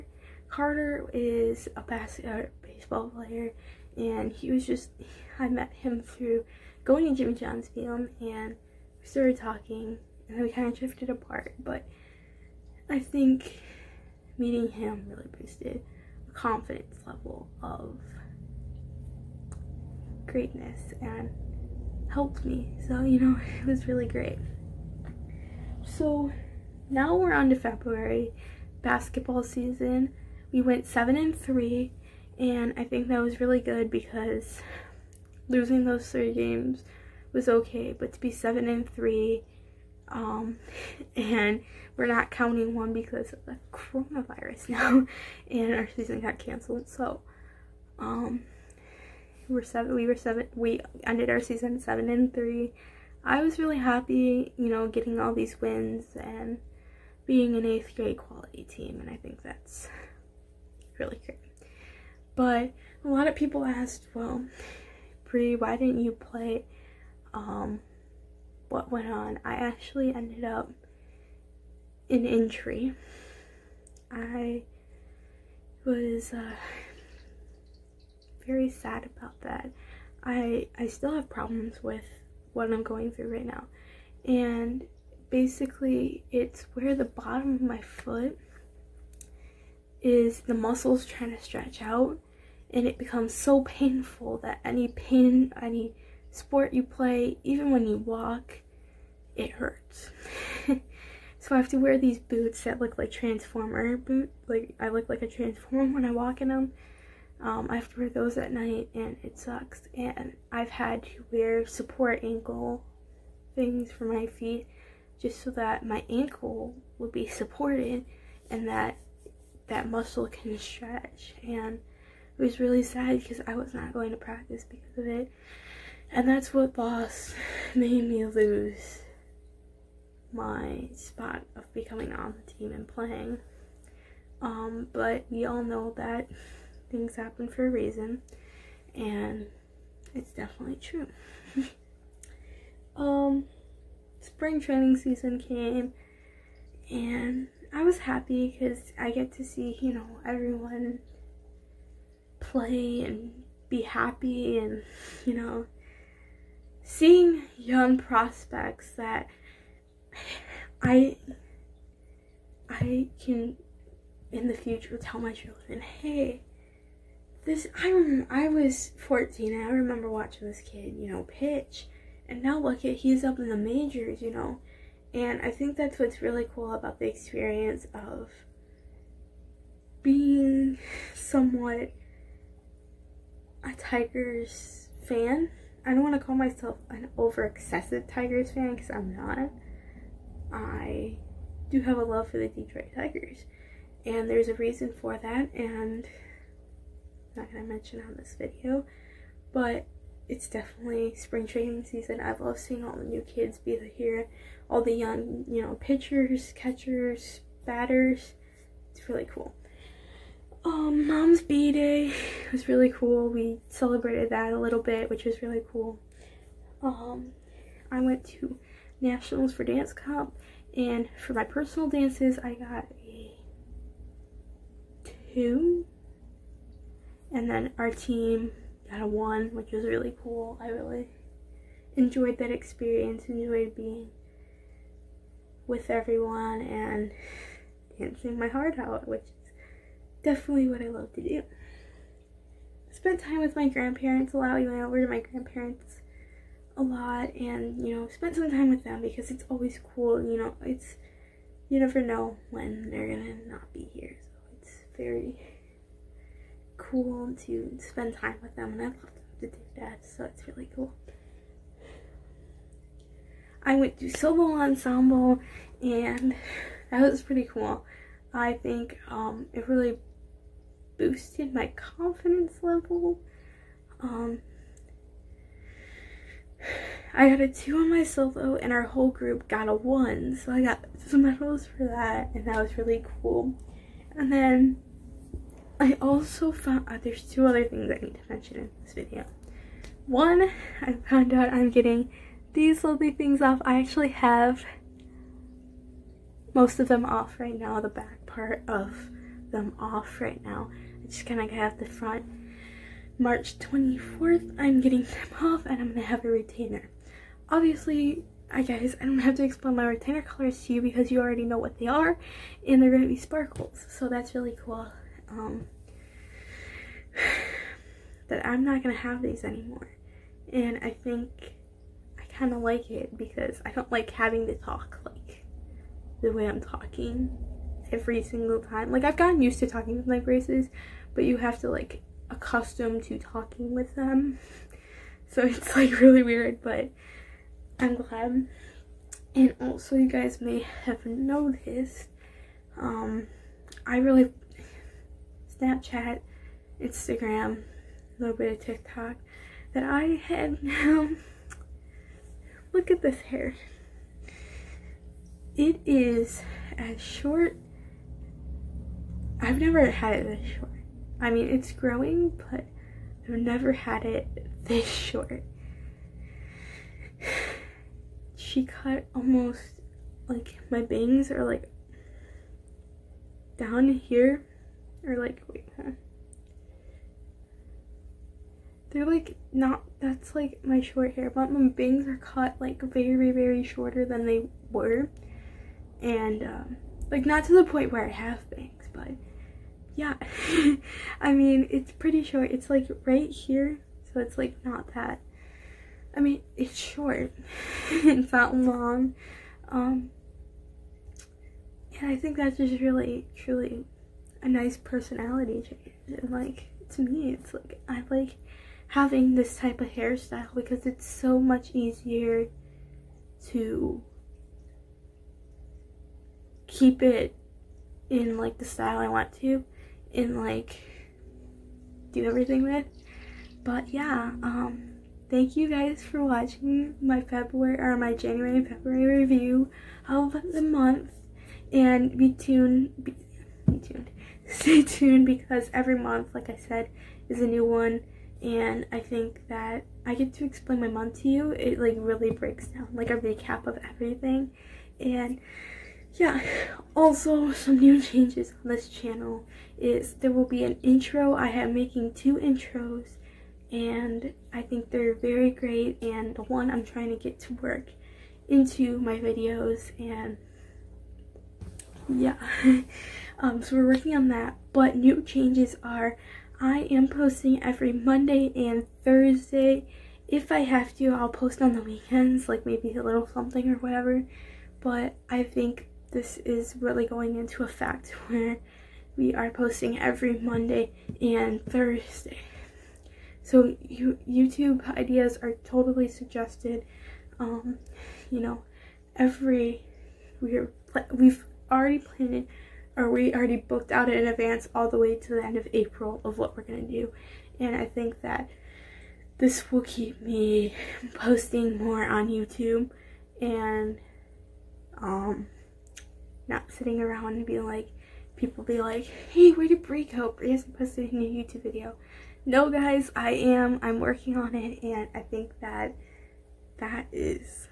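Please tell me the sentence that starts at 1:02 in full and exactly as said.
But a lot of people asked, well, Bri, why didn't you play um, what went on?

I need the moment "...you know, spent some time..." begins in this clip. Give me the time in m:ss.
4:07.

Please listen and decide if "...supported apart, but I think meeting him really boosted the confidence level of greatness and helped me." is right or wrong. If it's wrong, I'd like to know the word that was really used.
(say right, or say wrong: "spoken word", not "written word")
wrong: "drifted", not "supported".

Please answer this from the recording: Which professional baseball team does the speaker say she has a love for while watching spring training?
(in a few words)
Detroit Tigers.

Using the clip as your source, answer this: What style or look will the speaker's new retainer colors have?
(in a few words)
sparkles.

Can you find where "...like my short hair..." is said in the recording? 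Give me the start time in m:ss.
6:20.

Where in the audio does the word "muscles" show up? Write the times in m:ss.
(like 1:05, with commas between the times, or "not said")
1:30, 1:59.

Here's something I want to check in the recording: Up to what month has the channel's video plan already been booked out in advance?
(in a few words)
April.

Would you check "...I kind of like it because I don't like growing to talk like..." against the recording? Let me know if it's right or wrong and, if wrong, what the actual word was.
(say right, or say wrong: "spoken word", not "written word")
wrong: "having", not "growing".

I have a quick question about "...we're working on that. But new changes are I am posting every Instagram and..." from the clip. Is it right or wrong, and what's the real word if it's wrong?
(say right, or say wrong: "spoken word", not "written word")
wrong: "Monday", not "Instagram".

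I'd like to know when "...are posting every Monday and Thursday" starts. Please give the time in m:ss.
7:59.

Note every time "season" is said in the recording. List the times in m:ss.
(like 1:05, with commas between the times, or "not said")
0:29, 0:45, 0:51, 2:24, 3:21.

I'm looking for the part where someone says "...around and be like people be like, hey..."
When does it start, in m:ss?
8:27.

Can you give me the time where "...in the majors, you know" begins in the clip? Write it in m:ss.
2:53.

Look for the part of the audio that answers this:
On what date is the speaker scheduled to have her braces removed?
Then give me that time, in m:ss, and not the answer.
5:03.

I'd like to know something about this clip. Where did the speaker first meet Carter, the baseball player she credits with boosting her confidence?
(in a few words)
Jimmy John's.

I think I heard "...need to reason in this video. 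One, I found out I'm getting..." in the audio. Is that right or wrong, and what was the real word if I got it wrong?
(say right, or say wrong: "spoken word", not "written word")
wrong: "mention", not "reason".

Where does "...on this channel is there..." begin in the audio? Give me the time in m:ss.
7:28.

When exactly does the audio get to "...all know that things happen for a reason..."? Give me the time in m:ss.
2:15.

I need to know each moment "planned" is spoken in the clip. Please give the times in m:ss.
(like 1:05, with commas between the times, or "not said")
8:11.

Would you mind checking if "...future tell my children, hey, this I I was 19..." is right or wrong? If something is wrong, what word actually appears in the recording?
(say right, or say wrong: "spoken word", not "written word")
wrong: "14", not "19".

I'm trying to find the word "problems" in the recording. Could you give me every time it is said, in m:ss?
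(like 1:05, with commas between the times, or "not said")
1:21.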